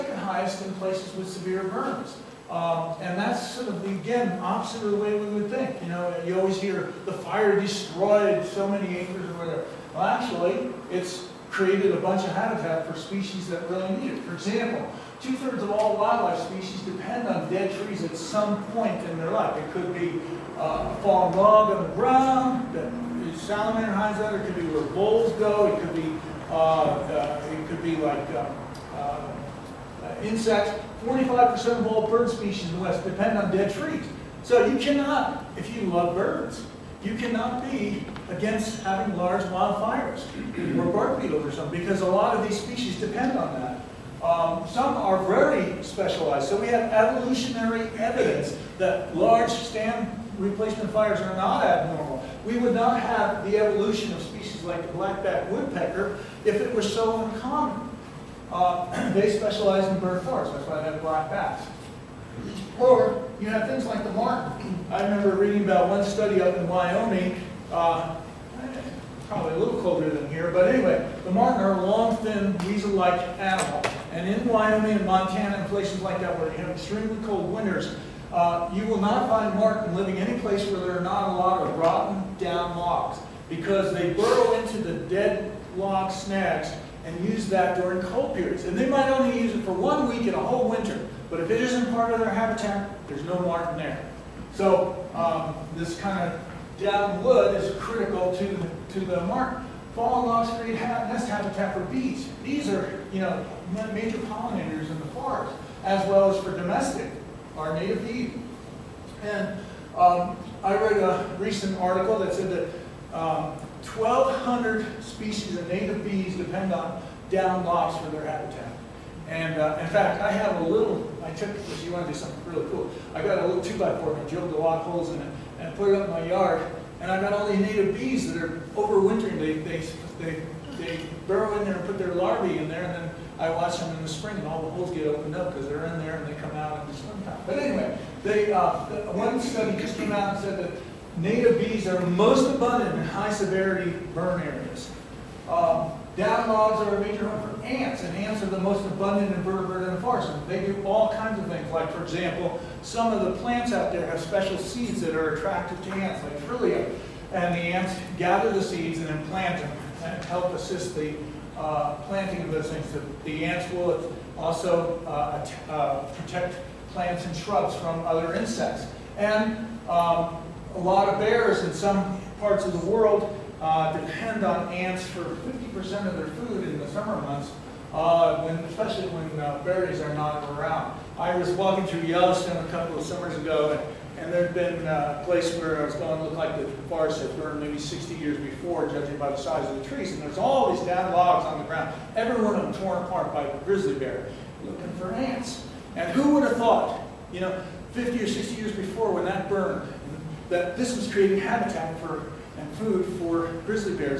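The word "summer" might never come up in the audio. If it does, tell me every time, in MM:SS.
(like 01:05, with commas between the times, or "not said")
02:56, 03:03.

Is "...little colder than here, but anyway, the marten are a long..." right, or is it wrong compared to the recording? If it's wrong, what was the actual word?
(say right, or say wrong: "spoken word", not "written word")
right.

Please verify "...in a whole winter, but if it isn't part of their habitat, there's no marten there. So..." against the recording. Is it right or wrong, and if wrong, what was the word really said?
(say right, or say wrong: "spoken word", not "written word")
right.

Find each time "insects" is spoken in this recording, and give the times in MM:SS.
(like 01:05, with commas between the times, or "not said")
00:30, 02:48.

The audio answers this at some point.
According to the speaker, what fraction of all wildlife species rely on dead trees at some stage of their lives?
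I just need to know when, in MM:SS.
00:15.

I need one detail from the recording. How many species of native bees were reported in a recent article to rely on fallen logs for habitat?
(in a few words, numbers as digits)
1,200.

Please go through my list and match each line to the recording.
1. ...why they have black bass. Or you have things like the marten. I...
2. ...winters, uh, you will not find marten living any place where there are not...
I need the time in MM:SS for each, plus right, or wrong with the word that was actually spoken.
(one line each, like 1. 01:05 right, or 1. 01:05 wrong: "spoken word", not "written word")
1. 01:00 right
2. 01:17 right.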